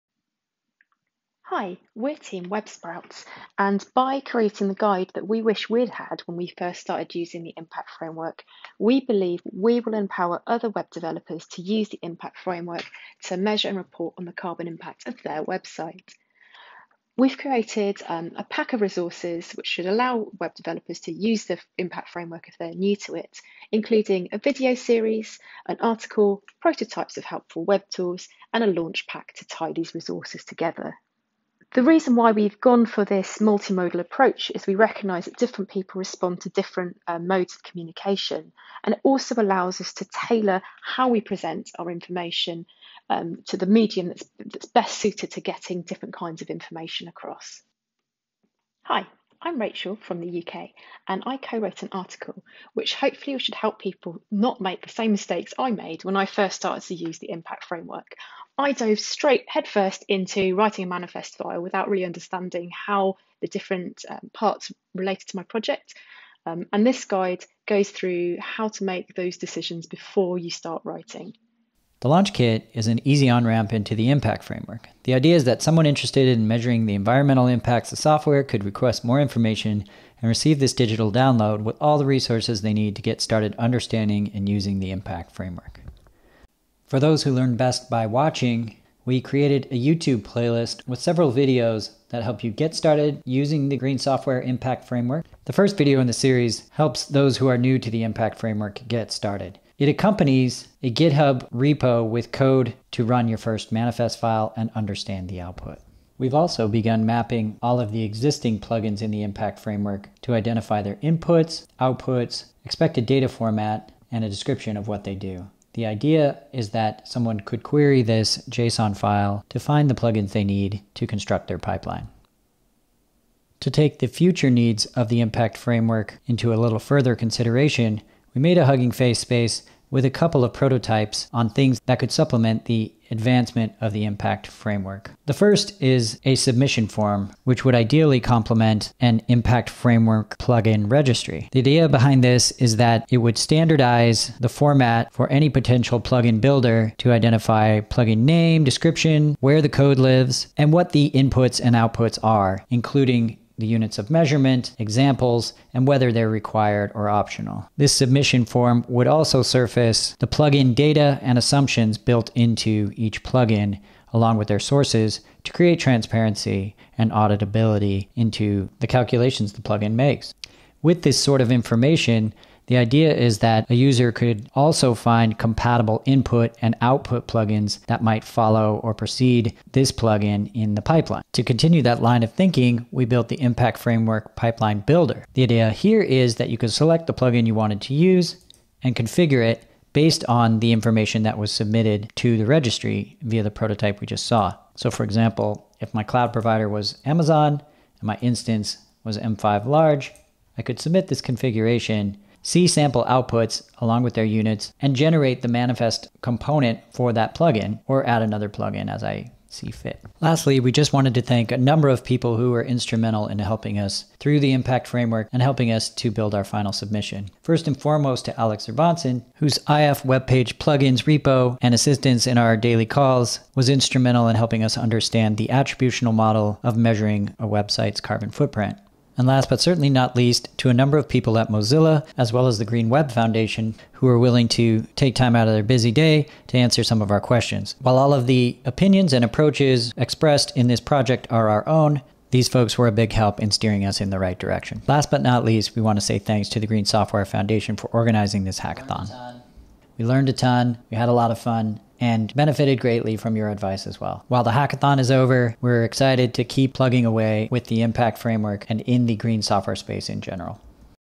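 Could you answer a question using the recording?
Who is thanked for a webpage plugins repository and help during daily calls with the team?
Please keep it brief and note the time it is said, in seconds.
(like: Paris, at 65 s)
Alex zur Bonsen, at 218 s.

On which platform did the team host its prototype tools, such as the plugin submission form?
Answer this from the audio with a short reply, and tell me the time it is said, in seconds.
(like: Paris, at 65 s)
Hugging Face, at 128 s.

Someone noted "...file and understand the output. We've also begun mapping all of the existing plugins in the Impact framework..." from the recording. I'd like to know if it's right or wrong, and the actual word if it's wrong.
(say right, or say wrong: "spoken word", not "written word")
right.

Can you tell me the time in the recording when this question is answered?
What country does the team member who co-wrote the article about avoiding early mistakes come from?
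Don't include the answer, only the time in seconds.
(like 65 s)
50 s.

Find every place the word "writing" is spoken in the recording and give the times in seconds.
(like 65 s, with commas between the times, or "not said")
60 s, 70 s.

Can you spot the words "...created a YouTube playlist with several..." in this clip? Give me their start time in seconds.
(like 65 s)
89 s.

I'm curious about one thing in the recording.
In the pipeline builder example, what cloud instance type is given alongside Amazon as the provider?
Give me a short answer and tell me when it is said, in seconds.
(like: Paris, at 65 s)
M5 large, at 199 s.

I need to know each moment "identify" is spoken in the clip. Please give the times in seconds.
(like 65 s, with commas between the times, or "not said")
110 s, 147 s.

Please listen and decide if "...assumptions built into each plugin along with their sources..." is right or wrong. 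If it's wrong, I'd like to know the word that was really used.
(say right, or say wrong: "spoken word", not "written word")
right.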